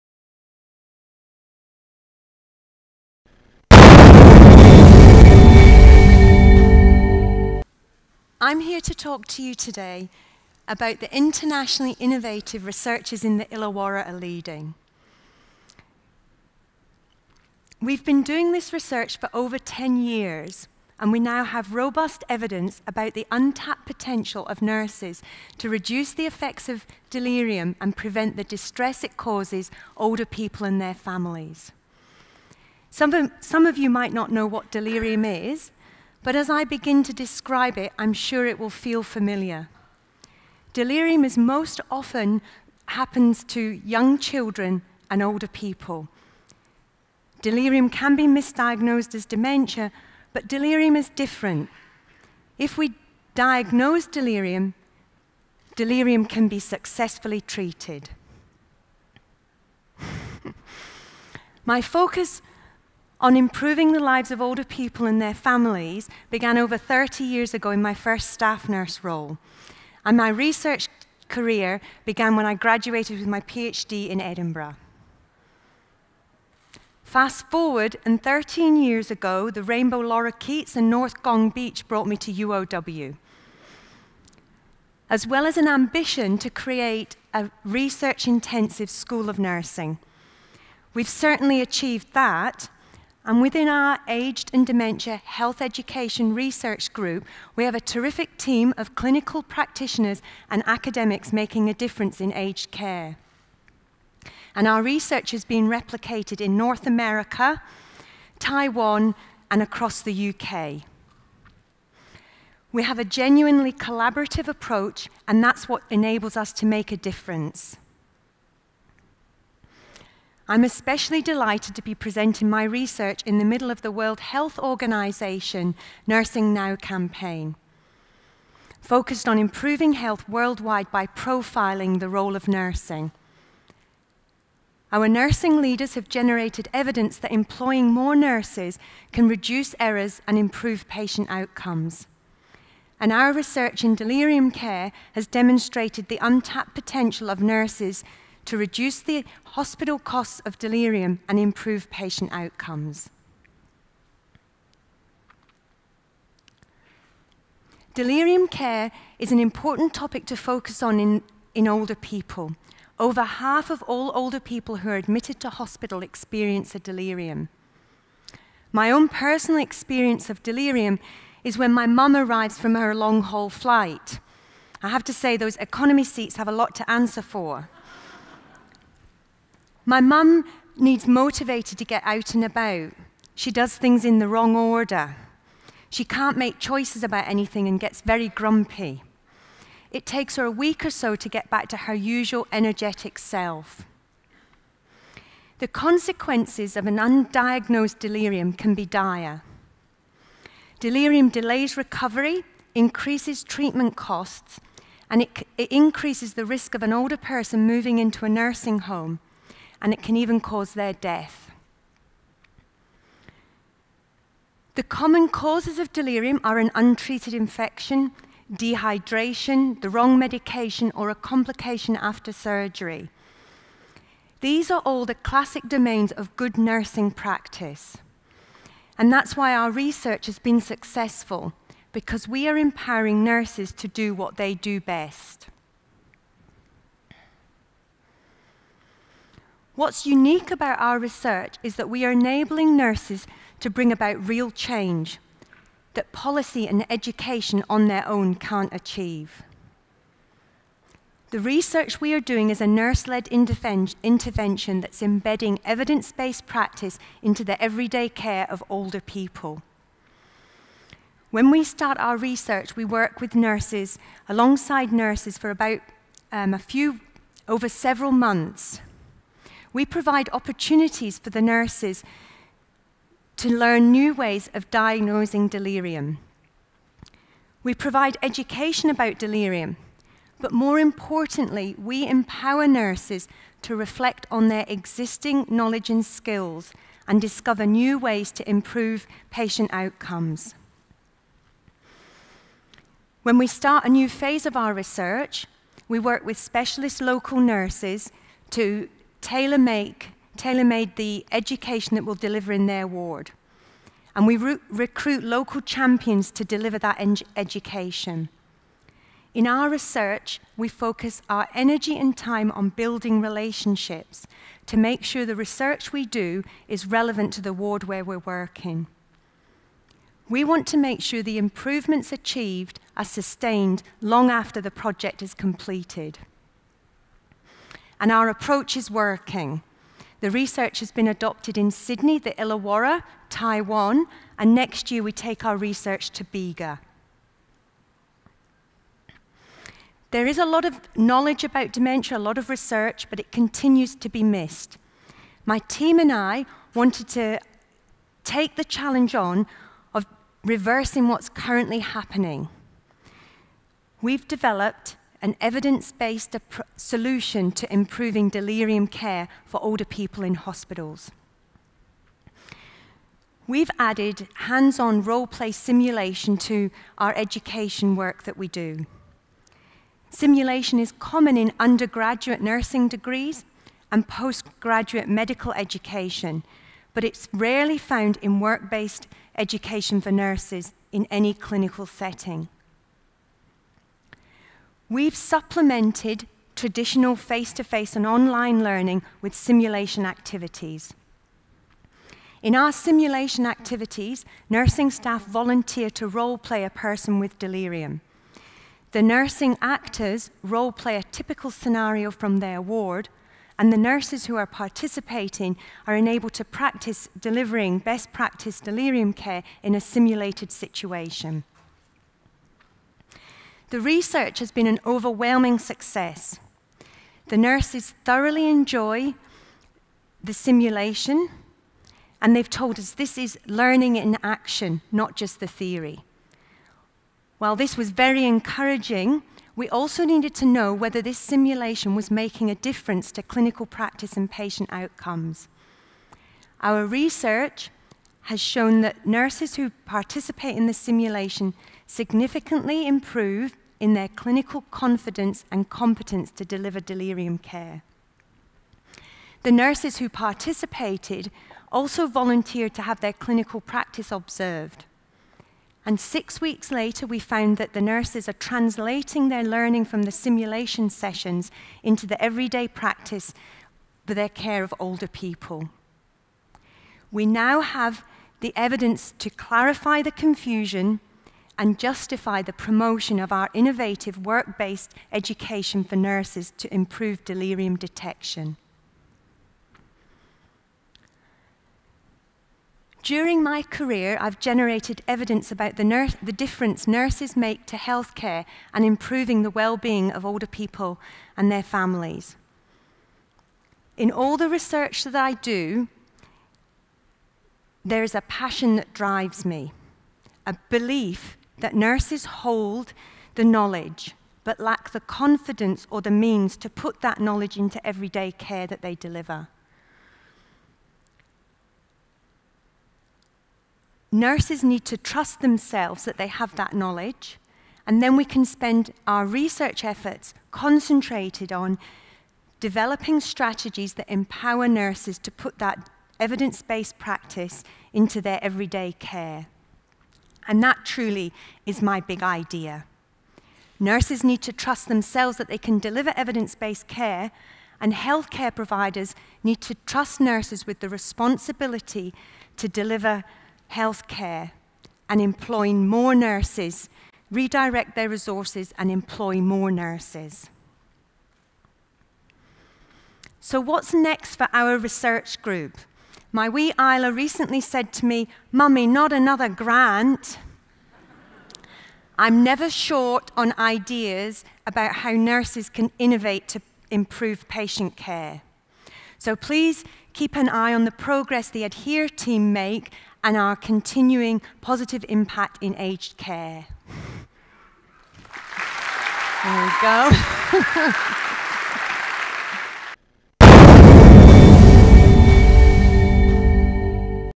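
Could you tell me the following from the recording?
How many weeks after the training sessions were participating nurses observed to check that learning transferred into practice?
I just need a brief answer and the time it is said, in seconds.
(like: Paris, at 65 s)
6, at 455 s.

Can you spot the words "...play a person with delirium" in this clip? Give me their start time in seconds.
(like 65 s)
396 s.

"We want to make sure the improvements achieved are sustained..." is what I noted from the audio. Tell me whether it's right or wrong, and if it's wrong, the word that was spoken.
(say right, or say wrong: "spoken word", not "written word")
right.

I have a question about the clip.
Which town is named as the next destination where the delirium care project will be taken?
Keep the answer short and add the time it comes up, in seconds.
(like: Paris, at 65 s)
Bega, at 336 s.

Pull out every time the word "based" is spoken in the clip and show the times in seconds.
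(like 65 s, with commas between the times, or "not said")
256 s, 355 s, 378 s, 474 s, 526 s, 536 s.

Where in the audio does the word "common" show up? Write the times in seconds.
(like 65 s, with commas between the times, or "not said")
214 s, 370 s.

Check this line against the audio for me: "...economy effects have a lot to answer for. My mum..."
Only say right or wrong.
wrong.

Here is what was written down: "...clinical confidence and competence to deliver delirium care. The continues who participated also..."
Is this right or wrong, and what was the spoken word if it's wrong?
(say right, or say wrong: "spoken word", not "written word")
wrong: "nurses", not "continues".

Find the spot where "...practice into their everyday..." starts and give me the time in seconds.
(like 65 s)
526 s.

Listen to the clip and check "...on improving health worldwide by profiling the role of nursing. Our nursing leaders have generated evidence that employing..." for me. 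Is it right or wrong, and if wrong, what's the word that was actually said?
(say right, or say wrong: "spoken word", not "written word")
right.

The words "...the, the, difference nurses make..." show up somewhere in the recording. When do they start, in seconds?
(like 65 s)
485 s.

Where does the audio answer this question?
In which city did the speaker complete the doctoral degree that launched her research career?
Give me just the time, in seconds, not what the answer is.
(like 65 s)
74 s.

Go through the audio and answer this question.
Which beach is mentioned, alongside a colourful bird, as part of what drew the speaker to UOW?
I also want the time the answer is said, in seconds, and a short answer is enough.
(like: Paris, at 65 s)
North Gong Beach, at 80 s.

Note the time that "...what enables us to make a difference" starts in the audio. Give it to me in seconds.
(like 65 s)
115 s.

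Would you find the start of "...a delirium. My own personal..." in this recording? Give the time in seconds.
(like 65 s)
166 s.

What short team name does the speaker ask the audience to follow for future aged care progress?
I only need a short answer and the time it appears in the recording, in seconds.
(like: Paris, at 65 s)
Adhere, at 571 s.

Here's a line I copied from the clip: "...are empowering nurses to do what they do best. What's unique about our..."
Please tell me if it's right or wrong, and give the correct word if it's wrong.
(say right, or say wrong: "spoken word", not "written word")
right.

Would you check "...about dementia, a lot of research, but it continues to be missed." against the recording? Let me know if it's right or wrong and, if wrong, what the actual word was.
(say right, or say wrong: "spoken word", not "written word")
right.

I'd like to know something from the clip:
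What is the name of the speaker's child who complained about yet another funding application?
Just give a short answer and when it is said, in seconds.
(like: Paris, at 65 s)
Isla, at 556 s.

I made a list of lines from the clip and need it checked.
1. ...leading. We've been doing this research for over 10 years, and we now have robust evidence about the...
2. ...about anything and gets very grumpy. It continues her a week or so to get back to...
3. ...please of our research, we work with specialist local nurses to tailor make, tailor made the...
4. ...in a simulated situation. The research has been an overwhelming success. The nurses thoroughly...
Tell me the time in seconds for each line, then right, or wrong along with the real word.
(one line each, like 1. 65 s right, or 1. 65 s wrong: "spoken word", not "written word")
1. 14 s right
2. 187 s wrong: "takes", not "continues"
3. 294 s wrong: "phase", not "please"
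4. 409 s right.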